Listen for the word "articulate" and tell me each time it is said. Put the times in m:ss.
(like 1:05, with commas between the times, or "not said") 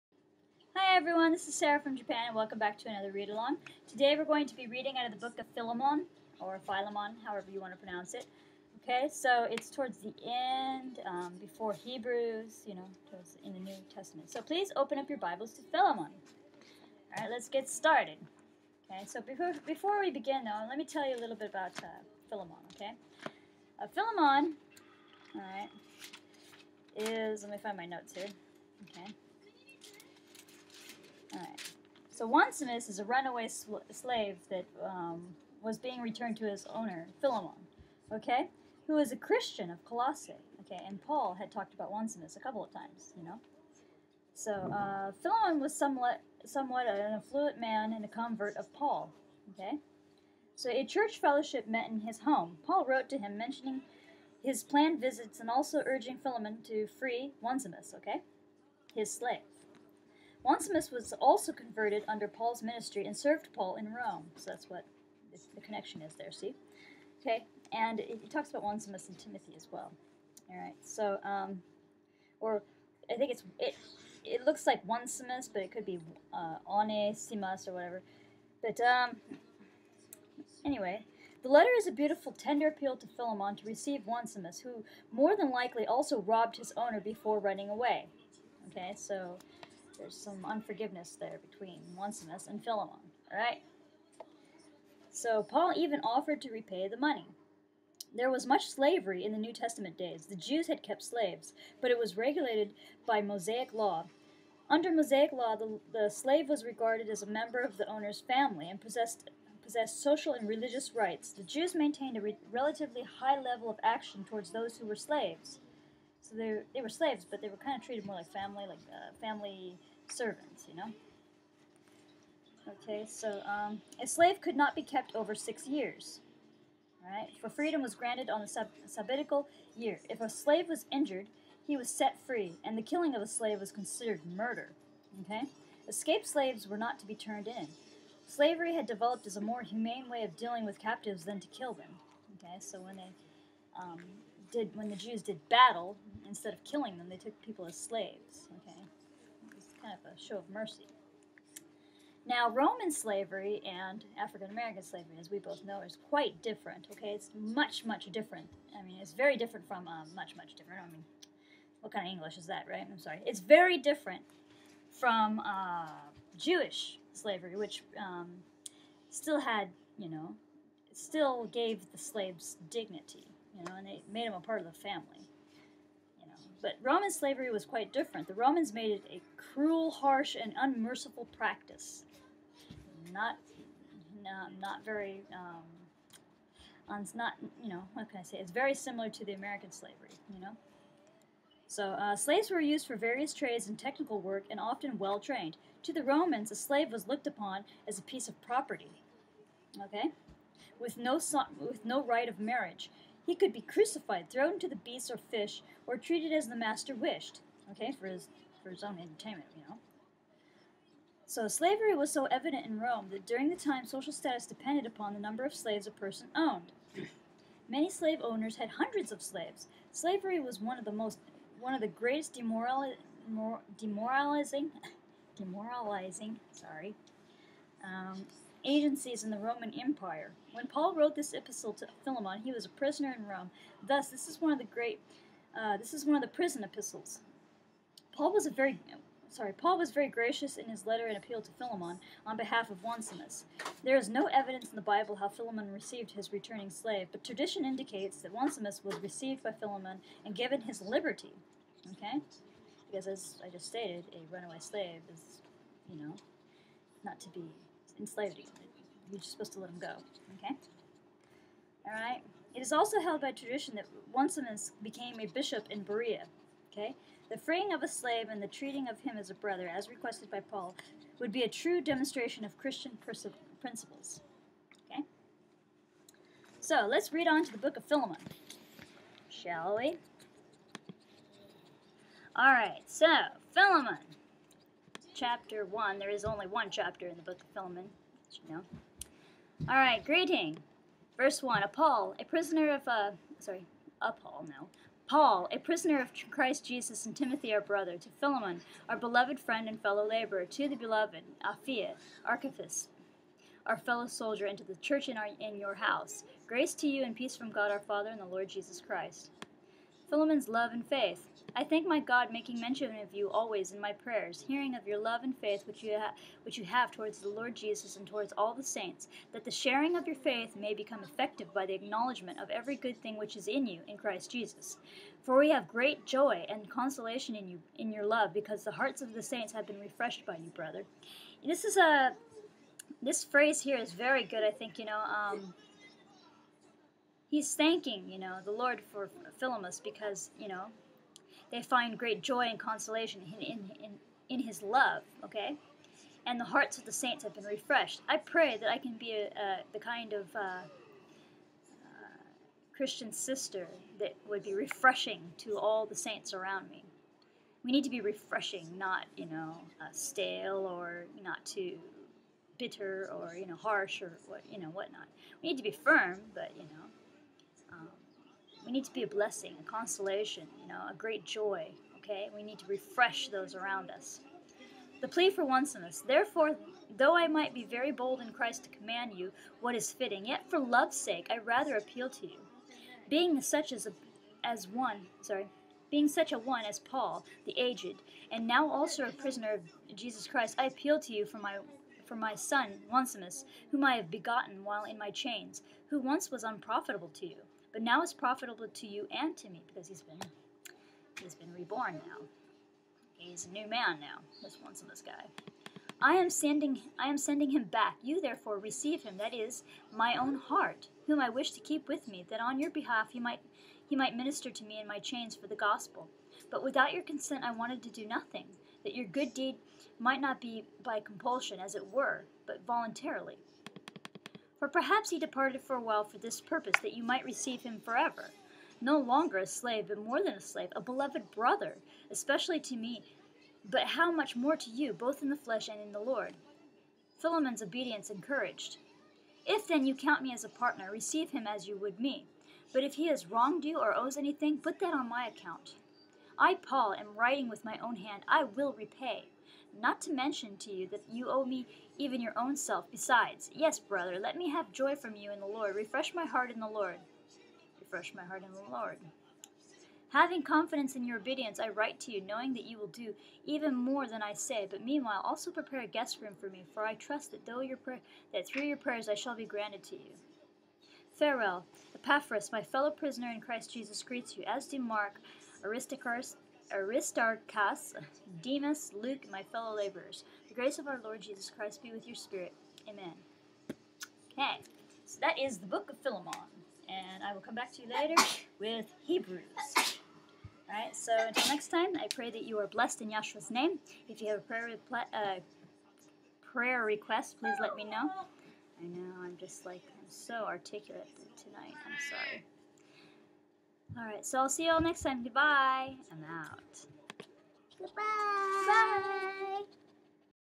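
8:20.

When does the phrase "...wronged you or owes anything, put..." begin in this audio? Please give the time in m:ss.
7:23.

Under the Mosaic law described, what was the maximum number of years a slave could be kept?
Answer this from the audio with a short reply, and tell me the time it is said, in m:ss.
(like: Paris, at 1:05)
6, at 2:05.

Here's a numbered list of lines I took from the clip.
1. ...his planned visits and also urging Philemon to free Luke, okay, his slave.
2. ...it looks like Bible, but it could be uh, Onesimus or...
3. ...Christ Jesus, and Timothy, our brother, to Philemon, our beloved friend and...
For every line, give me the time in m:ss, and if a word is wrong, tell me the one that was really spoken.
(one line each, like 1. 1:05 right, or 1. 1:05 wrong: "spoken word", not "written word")
1. 0:54 wrong: "Onesimus", not "Luke"
2. 1:14 wrong: "Onesimus", not "Bible"
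3. 4:56 right.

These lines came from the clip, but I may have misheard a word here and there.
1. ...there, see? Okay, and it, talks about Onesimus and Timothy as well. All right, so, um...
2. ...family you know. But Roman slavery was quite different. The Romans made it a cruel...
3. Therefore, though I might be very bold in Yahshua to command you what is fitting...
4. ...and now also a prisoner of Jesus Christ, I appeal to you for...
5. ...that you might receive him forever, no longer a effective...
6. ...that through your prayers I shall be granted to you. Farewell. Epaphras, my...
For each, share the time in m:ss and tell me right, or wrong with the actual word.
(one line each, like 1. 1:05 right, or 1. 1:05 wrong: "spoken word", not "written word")
1. 1:06 right
2. 2:54 right
3. 6:16 wrong: "Christ", not "Yahshua"
4. 6:28 right
5. 7:06 wrong: "slave", not "effective"
6. 7:48 right.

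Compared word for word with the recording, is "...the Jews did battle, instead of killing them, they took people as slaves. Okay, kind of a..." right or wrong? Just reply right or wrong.
right.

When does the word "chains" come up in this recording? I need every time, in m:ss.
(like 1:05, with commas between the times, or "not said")
6:35, 6:54.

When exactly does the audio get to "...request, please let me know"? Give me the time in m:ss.
8:16.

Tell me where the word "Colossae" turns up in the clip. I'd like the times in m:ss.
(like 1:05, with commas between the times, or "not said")
0:39.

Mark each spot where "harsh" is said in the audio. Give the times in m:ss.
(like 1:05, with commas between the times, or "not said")
2:59, 6:03.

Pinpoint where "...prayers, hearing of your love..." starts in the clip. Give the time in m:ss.
5:13.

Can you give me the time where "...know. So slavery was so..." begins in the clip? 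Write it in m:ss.
3:29.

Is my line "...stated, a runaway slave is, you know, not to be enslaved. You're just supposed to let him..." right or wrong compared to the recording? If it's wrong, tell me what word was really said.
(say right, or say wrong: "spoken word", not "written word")
right.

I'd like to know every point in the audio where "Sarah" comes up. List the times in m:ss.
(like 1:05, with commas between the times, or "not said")
0:01.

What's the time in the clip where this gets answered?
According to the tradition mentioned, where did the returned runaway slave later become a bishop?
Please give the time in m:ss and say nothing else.
4:25.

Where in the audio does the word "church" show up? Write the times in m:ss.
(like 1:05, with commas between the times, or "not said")
0:50, 5:04.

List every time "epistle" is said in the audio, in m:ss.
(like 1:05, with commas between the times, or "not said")
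3:51, 3:56.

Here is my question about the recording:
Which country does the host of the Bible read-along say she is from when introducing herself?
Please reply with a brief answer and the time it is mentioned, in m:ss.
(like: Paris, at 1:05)
Japan, at 0:01.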